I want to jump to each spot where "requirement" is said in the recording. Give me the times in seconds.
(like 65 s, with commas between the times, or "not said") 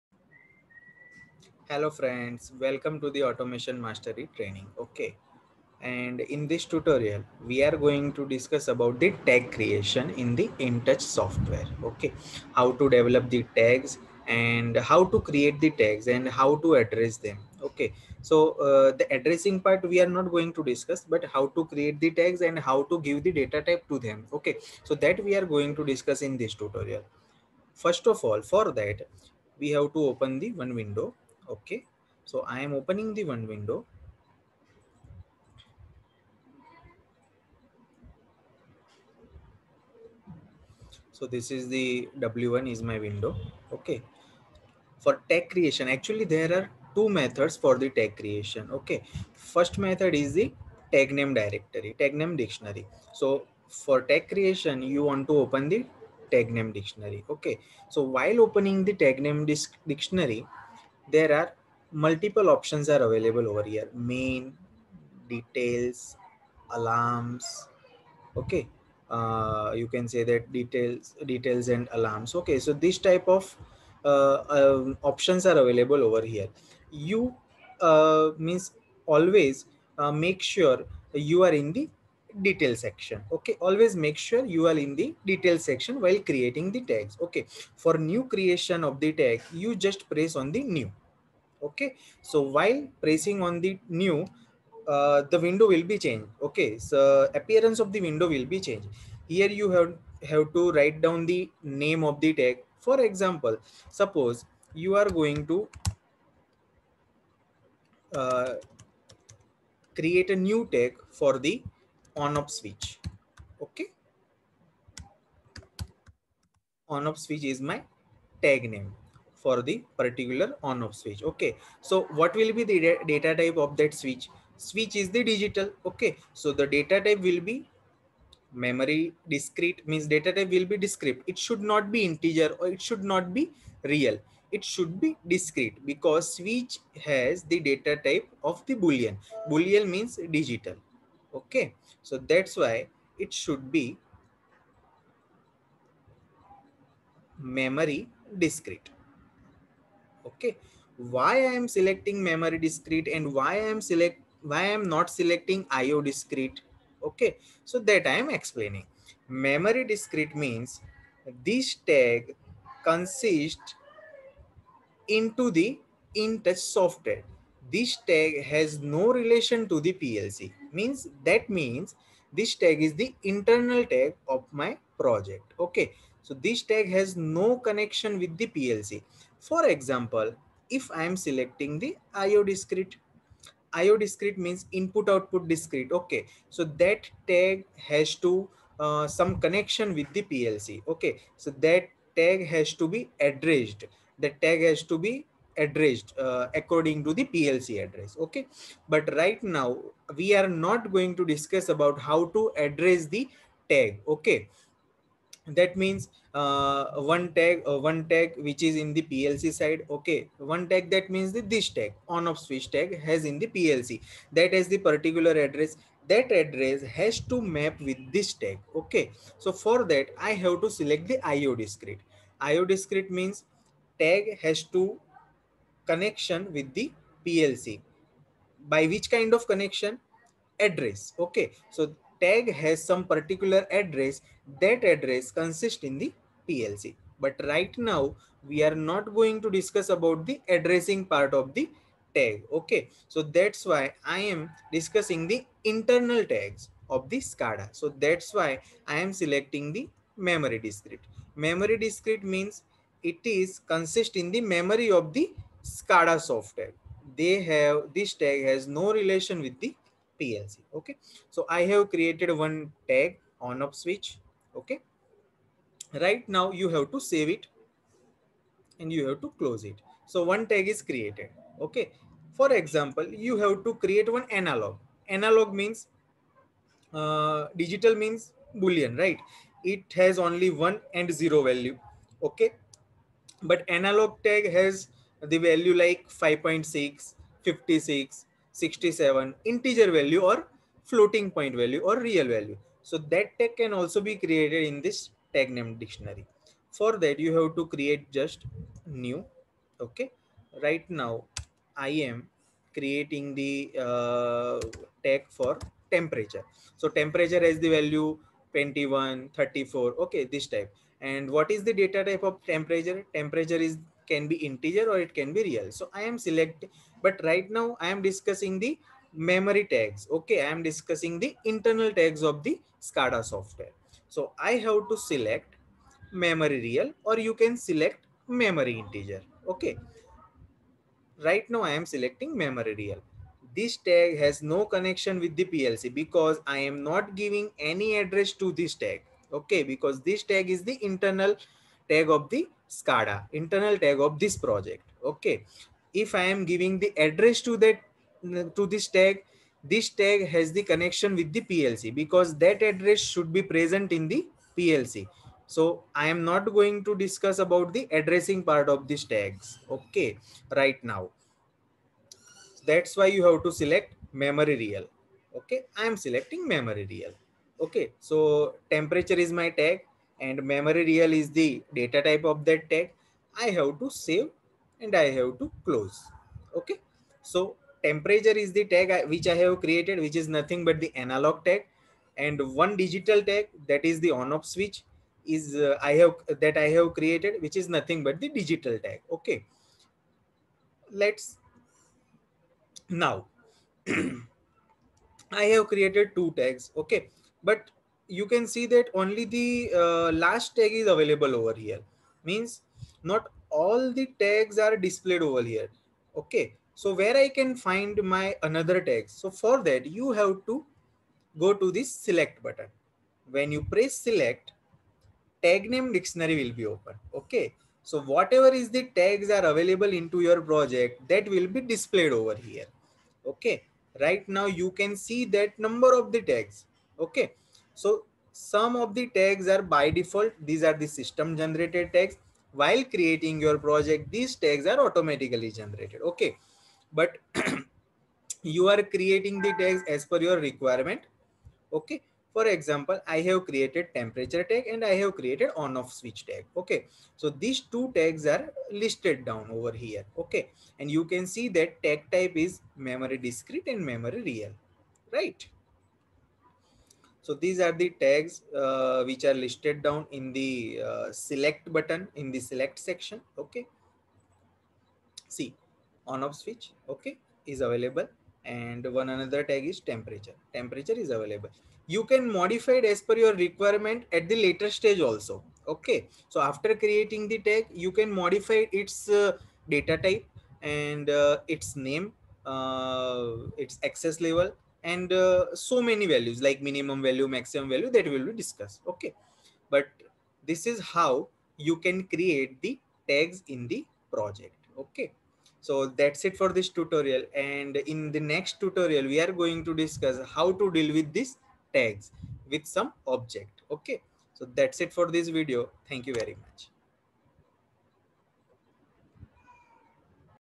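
440 s, 473 s.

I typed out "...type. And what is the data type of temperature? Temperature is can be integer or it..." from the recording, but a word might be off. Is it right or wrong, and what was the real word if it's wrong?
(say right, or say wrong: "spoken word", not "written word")
right.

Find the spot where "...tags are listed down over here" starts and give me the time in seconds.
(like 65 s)
447 s.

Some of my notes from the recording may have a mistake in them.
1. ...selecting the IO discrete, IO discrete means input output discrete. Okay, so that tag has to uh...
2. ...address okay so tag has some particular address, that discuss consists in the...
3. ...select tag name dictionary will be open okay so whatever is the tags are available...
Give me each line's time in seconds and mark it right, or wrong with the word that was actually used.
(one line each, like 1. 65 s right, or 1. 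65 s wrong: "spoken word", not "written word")
1. 181 s right
2. 230 s wrong: "address", not "discuss"
3. 414 s right.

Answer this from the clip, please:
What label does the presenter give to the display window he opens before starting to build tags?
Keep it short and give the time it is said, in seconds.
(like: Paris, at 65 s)
W1, at 42 s.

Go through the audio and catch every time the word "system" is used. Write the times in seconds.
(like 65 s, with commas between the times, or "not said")
430 s.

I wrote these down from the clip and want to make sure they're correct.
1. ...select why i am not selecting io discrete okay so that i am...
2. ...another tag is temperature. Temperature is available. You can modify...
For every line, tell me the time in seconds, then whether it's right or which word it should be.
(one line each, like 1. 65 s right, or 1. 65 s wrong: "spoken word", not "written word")
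1. 153 s right
2. 469 s right.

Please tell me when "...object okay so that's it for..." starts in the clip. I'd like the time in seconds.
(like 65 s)
503 s.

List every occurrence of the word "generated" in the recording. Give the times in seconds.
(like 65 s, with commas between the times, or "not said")
431 s, 435 s.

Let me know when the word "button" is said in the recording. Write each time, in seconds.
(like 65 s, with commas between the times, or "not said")
412 s, 461 s.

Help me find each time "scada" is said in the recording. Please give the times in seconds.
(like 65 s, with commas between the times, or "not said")
247 s, 255 s, 322 s, 342 s.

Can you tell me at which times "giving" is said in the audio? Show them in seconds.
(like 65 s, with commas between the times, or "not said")
337 s, 346 s.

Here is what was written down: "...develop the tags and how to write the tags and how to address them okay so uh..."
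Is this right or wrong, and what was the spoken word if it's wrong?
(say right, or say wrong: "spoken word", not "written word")
wrong: "create", not "write".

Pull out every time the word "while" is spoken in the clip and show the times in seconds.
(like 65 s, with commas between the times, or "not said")
58 s, 85 s, 92 s, 432 s.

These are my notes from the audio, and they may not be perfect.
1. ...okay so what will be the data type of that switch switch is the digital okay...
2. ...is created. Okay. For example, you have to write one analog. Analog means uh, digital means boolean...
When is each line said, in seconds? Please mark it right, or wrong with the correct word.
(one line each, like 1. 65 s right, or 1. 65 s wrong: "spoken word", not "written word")
1. 121 s right
2. 270 s wrong: "create", not "write".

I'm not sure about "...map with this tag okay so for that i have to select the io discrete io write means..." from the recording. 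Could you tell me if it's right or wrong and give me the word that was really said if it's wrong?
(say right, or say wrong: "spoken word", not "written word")
wrong: "discrete", not "write".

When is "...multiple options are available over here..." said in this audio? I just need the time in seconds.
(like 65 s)
61 s.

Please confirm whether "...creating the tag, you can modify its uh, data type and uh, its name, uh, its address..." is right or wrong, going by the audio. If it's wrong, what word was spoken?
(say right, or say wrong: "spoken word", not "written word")
wrong: "access", not "address".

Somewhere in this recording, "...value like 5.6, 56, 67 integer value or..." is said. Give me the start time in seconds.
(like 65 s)
285 s.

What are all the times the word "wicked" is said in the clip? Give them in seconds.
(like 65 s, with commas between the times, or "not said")
not said.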